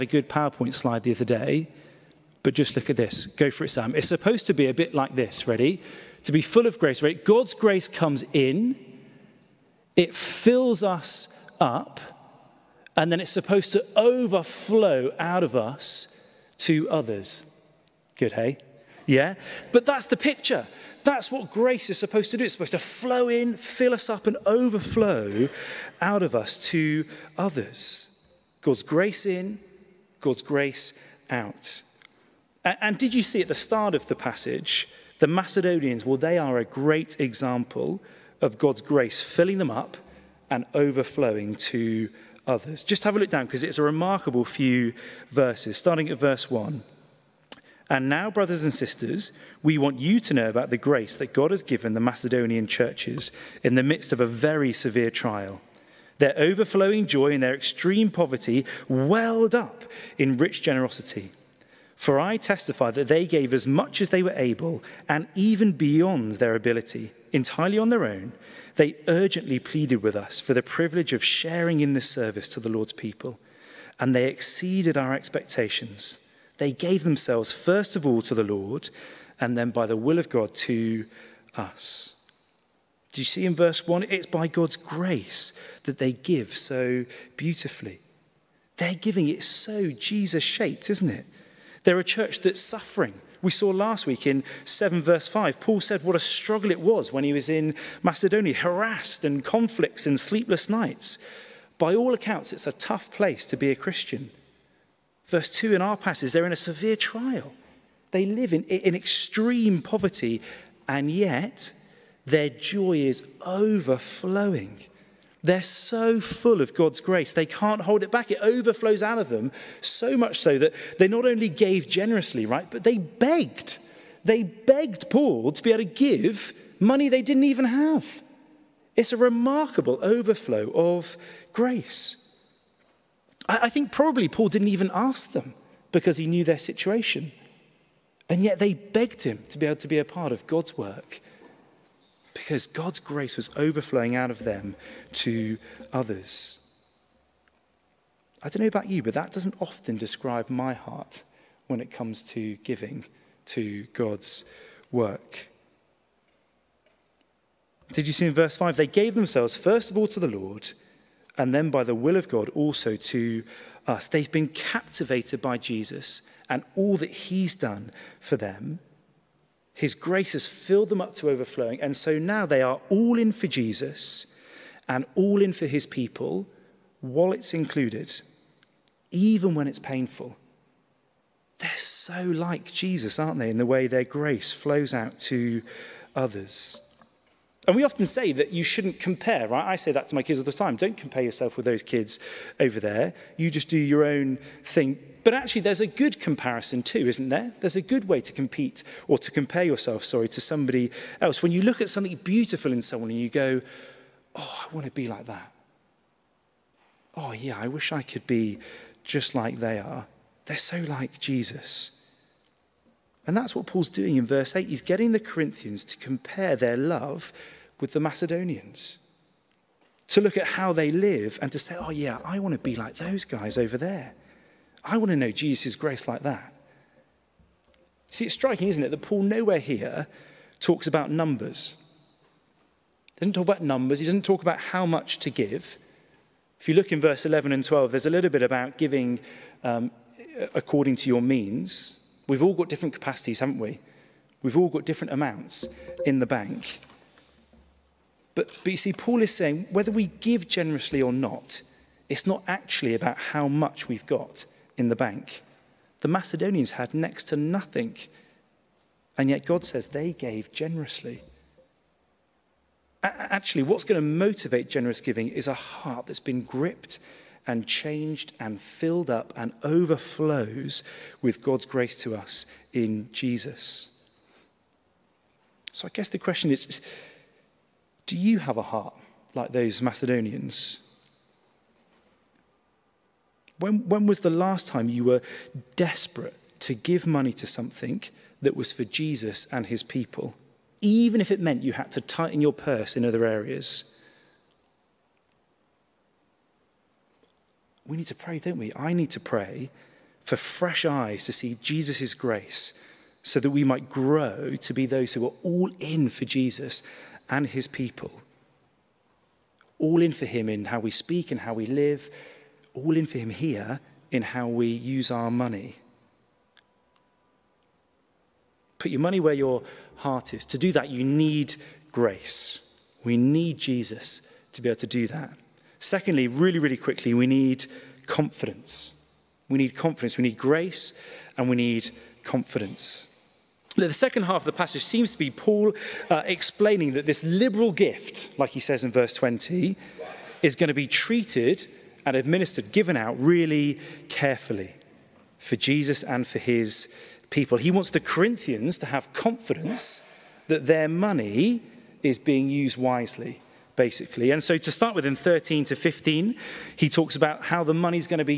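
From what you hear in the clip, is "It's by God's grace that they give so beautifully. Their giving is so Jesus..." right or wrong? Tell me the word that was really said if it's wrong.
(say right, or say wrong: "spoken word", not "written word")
right.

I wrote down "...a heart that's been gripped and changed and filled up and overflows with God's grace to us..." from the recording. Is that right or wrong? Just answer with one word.
right.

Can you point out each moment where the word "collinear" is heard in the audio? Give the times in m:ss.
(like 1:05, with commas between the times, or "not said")
not said.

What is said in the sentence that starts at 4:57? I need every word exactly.
We need to pray, don't we?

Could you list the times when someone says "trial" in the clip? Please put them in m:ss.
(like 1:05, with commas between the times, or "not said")
0:55, 1:46.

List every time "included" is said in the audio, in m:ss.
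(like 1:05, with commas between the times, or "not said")
2:57.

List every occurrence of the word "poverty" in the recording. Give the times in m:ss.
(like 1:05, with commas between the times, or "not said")
0:58, 1:49.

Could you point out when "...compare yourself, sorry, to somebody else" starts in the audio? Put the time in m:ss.
3:19.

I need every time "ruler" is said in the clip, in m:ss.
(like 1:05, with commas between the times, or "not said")
not said.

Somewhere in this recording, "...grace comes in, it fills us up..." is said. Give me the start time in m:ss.
0:07.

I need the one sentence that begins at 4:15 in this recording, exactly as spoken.
The Macedonians had next to nothing, and yet God says they gave generously.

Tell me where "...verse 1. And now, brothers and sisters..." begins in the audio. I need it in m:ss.
0:46.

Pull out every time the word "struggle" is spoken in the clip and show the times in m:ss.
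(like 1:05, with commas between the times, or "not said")
1:36.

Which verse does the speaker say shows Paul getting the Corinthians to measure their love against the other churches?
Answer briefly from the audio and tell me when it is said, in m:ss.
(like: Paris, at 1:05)
verse 8, at 3:34.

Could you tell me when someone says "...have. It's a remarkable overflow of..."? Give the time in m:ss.
2:07.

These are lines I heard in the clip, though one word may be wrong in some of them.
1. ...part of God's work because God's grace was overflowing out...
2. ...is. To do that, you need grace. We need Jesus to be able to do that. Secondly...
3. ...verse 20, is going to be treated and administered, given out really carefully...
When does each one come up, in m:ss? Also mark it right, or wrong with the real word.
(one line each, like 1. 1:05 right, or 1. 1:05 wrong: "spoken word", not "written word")
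1. 2:20 right
2. 5:20 right
3. 5:38 right.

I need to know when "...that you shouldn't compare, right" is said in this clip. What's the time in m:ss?
3:08.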